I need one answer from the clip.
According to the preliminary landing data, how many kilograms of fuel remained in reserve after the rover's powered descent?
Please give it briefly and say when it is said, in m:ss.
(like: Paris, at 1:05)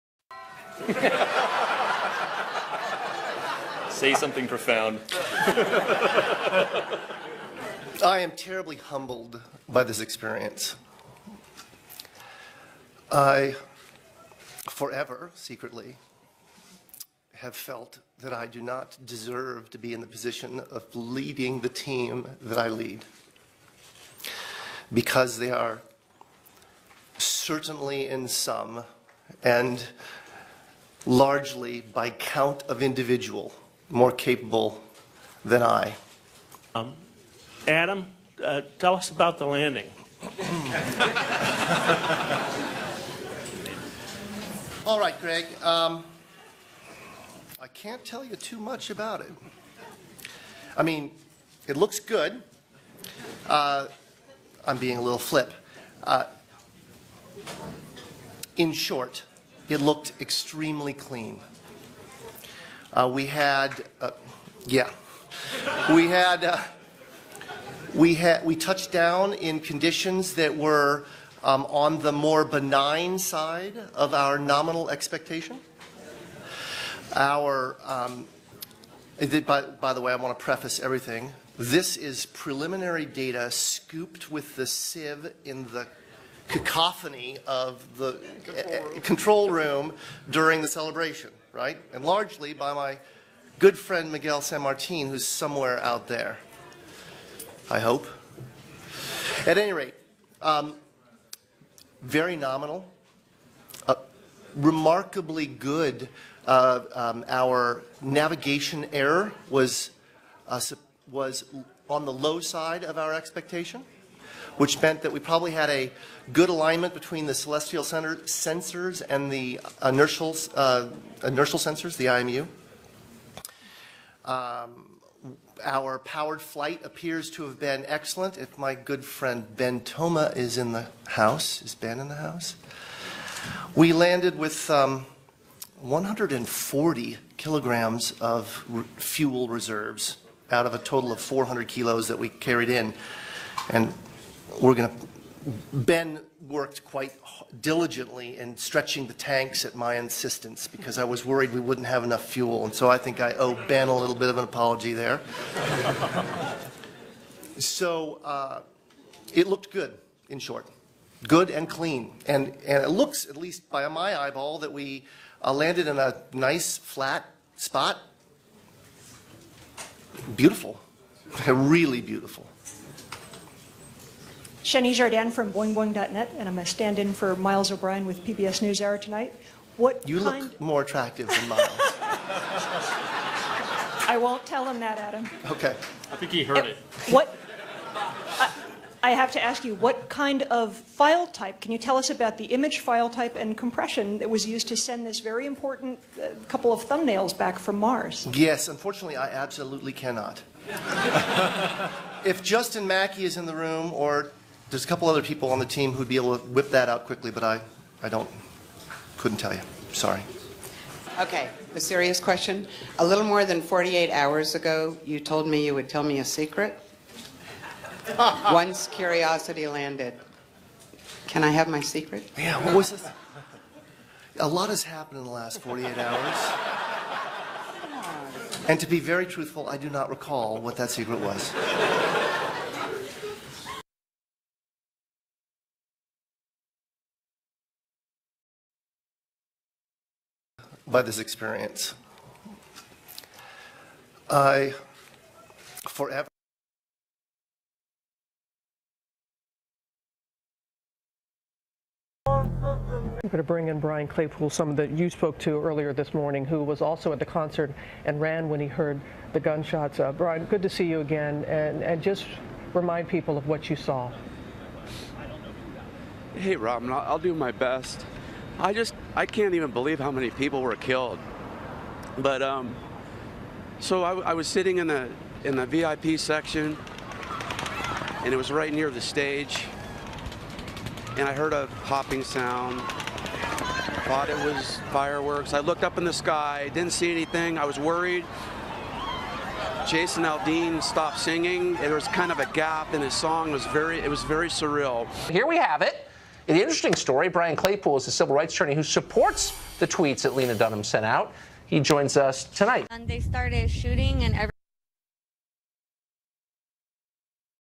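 140 kilograms, at 2:15.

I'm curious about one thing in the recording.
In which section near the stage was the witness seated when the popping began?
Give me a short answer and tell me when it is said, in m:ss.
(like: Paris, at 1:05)
VIP section, at 4:35.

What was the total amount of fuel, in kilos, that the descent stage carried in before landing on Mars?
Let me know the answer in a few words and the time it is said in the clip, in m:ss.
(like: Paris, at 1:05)
400 kilos, at 2:21.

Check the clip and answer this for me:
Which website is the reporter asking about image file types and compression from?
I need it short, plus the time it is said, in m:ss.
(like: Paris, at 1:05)
boingboing.net, at 2:55.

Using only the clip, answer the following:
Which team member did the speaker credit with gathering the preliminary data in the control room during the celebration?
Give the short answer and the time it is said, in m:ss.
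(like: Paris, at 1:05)
Miguel San Martin, at 1:34.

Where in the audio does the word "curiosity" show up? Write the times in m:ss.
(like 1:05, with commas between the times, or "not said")
3:38.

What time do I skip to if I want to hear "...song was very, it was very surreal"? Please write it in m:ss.
4:53.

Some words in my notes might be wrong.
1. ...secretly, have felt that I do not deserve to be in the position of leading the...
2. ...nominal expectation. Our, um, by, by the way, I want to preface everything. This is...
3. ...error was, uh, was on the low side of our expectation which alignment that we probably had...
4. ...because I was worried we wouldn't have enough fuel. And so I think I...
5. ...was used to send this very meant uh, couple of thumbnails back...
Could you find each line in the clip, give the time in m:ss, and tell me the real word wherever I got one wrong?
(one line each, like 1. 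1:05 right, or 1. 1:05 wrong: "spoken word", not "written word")
1. 0:15 right
2. 1:14 right
3. 1:48 wrong: "meant", not "alignment"
4. 2:30 right
5. 3:14 wrong: "important", not "meant".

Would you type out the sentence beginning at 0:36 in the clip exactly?
Um, Adam, uh, tell us about the landing.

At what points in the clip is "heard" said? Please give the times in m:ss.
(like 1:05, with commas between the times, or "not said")
3:06, 4:18, 4:41.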